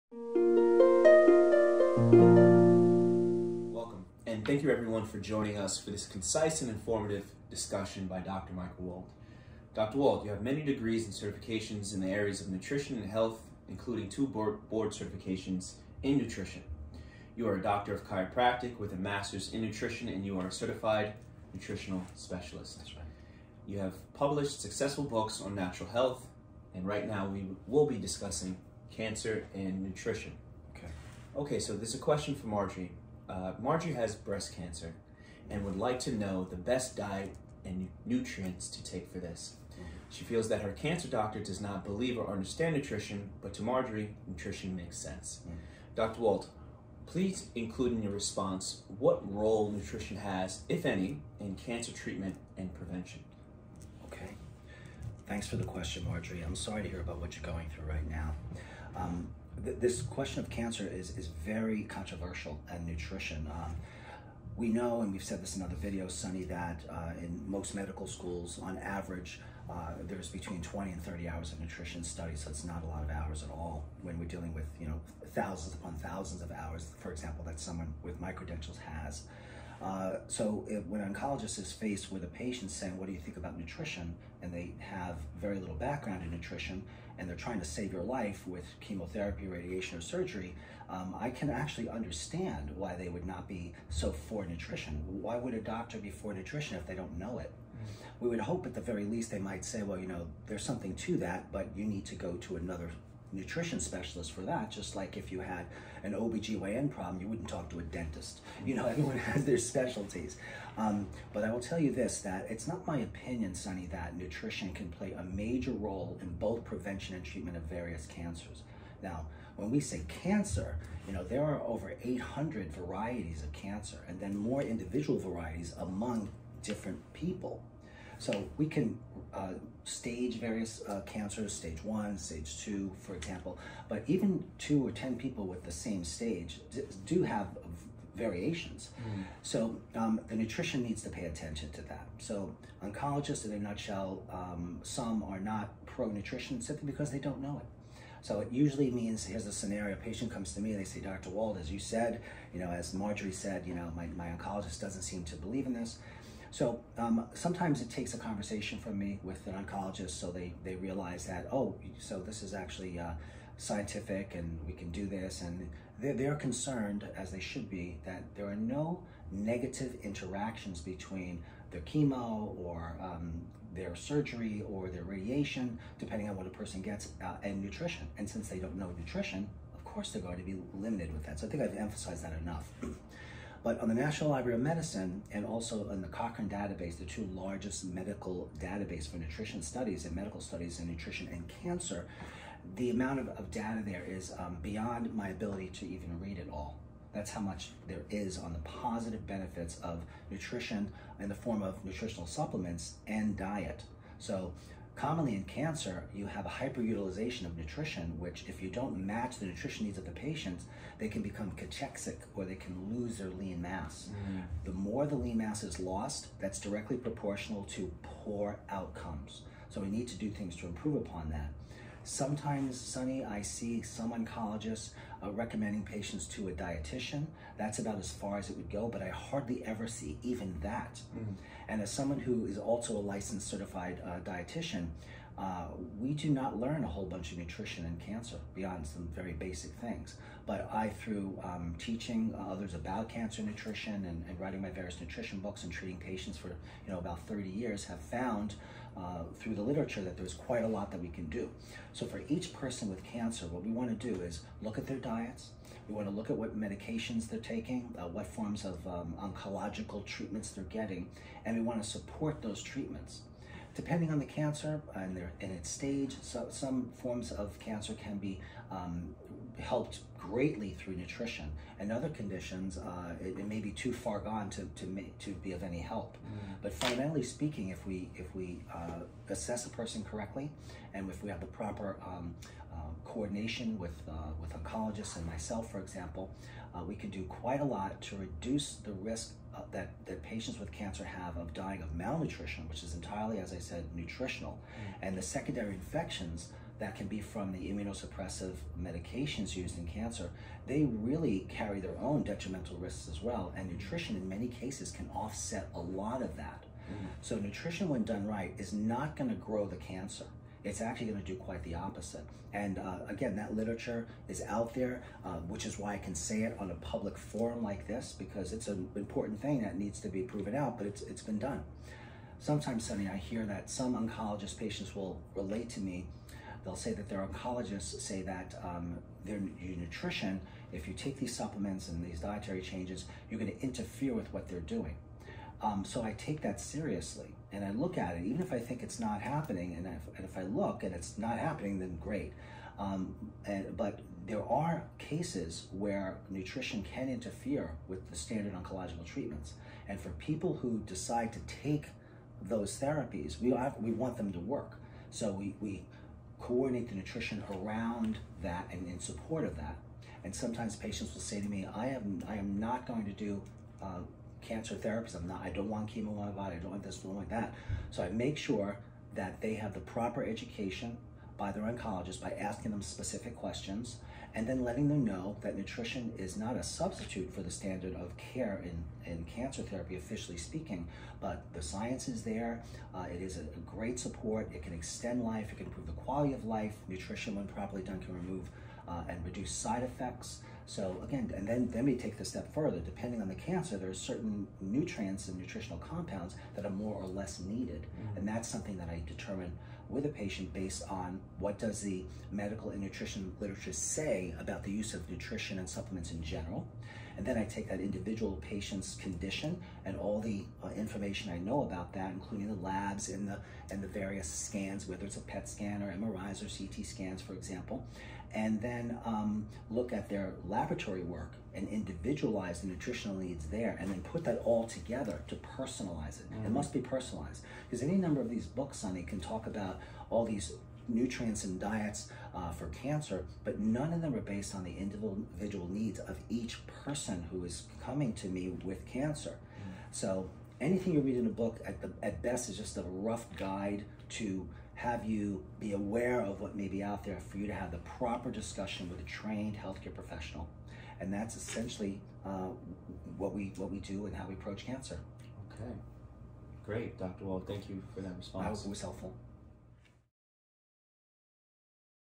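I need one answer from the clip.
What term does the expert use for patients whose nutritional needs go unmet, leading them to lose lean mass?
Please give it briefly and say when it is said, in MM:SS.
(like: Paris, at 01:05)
cachexic, at 03:31.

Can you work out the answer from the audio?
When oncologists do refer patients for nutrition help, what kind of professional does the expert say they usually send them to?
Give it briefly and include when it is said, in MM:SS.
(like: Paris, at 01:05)
a dietitian, at 03:46.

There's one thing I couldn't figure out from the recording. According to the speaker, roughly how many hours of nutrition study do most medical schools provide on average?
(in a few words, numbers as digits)
20 to 30 hours.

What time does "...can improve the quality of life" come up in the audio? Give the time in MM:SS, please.
06:25.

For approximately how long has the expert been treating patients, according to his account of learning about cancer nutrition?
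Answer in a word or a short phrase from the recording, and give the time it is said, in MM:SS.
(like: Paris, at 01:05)
about 30 years, at 04:06.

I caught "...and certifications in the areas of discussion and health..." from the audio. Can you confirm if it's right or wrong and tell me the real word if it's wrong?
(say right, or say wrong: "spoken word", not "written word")
wrong: "nutrition", not "discussion".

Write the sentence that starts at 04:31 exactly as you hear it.
And other conditions, uh, it, it, may be too far gone to, to, make, to be of any help.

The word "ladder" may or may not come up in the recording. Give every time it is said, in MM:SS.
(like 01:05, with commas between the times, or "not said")
not said.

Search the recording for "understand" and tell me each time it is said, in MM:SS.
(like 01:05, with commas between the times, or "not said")
00:42, 01:31.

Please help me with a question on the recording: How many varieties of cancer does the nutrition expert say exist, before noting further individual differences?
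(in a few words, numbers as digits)
over 800.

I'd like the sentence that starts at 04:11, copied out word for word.
So for each person with cancer, what we want to do is look at their diets.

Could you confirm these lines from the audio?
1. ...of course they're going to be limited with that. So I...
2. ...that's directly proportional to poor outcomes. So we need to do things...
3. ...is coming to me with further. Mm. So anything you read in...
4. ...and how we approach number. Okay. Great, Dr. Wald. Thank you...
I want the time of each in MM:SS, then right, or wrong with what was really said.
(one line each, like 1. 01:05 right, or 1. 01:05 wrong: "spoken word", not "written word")
1. 02:59 right
2. 03:36 right
3. 07:17 wrong: "cancer", not "further"
4. 07:34 wrong: "cancer", not "number".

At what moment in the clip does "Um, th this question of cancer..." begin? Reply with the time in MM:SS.
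00:58.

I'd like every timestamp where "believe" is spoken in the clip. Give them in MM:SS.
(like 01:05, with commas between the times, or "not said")
00:41, 02:35.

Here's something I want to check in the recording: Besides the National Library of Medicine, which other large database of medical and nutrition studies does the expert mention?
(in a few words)
Cochrane database.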